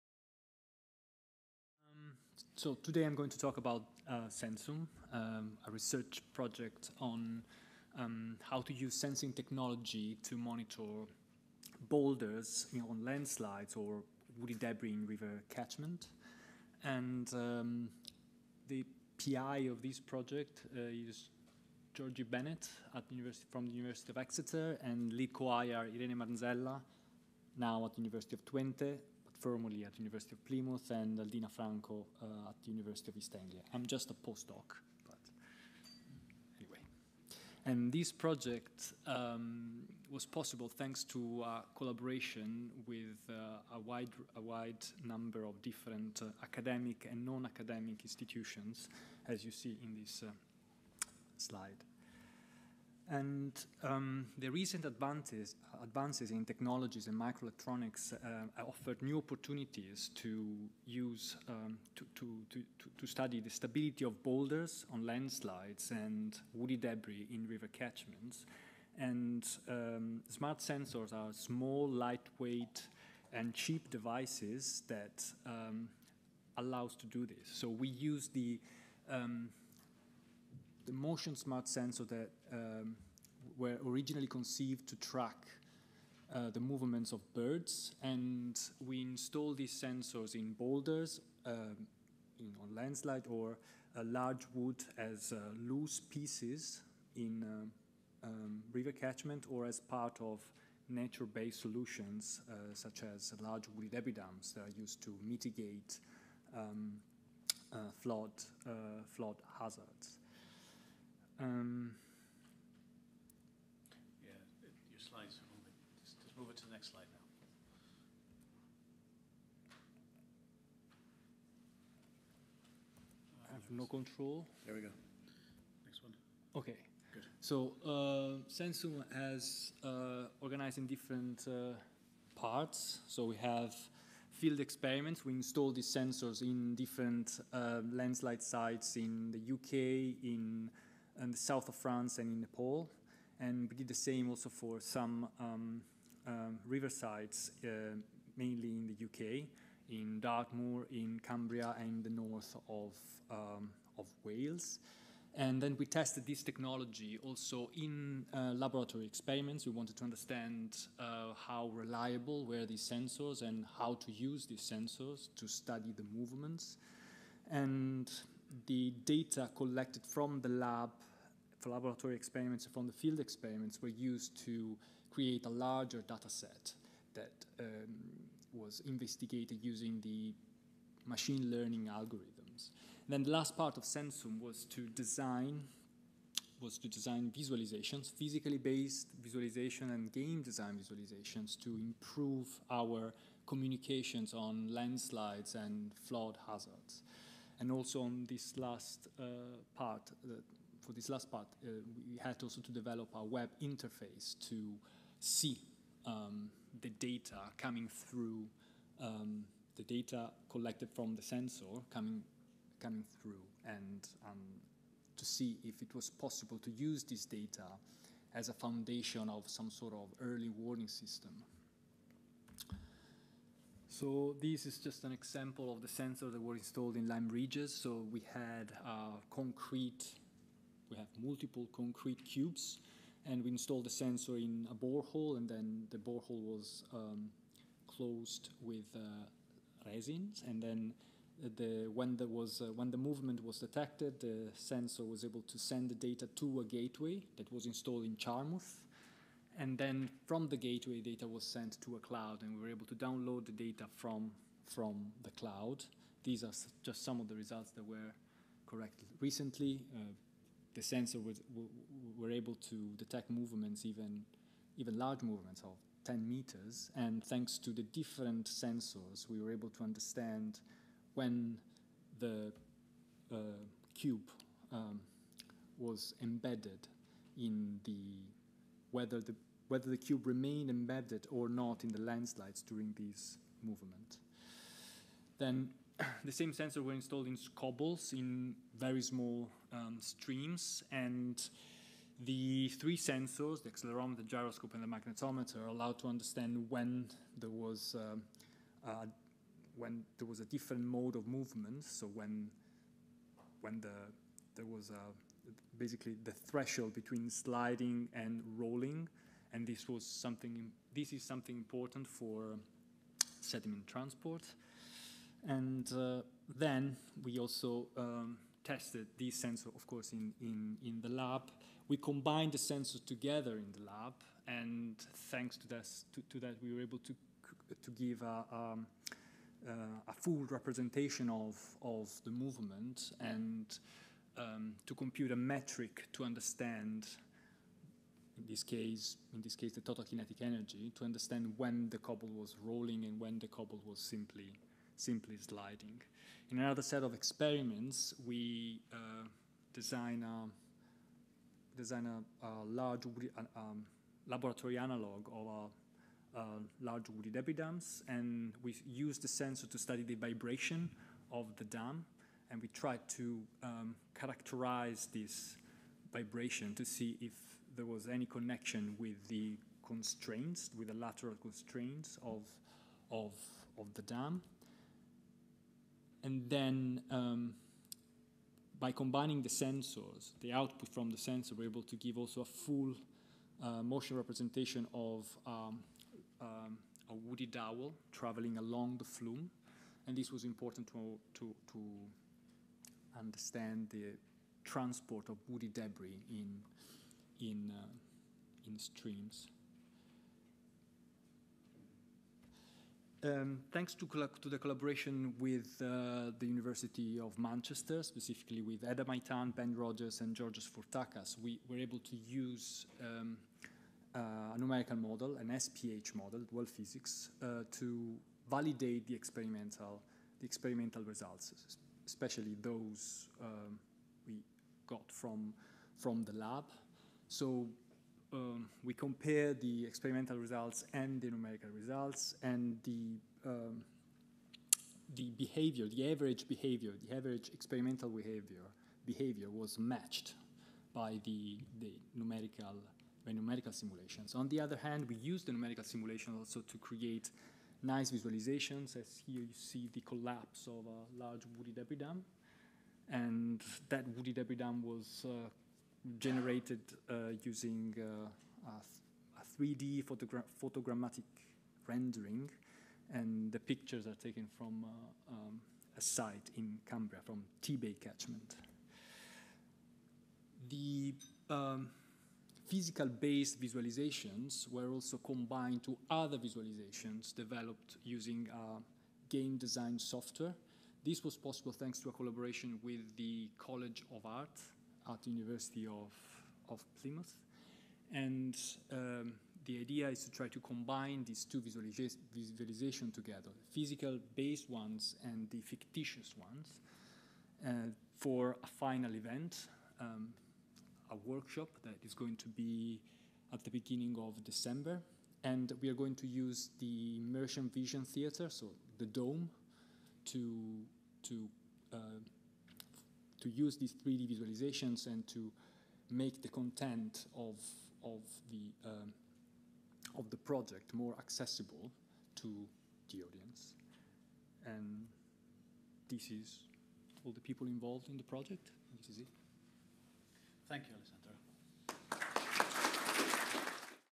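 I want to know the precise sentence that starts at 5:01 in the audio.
So when when the there was a, basically the threshold between sliding and rolling, and this was something.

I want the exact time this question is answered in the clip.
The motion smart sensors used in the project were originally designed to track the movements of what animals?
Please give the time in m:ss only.
1:27.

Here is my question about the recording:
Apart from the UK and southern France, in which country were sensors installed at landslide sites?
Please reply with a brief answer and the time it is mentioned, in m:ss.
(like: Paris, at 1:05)
Nepal, at 2:22.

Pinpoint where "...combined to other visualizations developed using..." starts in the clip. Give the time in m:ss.
7:55.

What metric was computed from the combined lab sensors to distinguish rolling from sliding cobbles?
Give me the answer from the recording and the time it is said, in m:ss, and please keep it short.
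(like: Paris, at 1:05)
Total kinetic energy, at 5:39.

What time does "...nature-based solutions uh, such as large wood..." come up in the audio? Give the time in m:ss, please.
1:40.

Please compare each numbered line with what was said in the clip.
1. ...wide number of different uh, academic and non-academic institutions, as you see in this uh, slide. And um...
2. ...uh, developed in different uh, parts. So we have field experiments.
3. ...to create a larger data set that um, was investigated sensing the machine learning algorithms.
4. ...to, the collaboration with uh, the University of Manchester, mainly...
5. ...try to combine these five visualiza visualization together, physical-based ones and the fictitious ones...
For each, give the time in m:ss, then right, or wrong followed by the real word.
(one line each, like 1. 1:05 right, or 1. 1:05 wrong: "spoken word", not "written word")
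1. 0:44 right
2. 2:09 wrong: "organized", not "developed"
3. 2:54 wrong: "using", not "sensing"
4. 6:44 wrong: "specifically", not "mainly"
5. 8:10 wrong: "two", not "five".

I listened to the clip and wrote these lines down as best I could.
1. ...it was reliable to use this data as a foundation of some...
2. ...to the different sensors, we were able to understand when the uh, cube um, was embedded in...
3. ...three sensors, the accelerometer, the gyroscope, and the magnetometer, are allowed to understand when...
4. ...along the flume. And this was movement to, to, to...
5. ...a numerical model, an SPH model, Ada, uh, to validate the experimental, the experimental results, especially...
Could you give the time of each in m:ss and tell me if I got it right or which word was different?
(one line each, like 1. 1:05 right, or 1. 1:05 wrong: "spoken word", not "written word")
1. 3:35 wrong: "possible", not "reliable"
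2. 4:27 right
3. 4:52 right
4. 6:28 wrong: "important", not "movement"
5. 6:54 wrong: "DualSPHysics", not "Ada".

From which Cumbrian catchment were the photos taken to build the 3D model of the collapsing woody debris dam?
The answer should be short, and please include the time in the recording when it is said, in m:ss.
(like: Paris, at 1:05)
Tebay, at 7:47.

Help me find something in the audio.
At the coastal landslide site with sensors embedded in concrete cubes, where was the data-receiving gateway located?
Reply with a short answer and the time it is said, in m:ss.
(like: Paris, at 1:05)
Charmouth, at 4:08.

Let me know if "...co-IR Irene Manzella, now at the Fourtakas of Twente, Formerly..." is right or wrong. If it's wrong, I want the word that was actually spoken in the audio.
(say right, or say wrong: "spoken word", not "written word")
wrong: "University", not "Fourtakas".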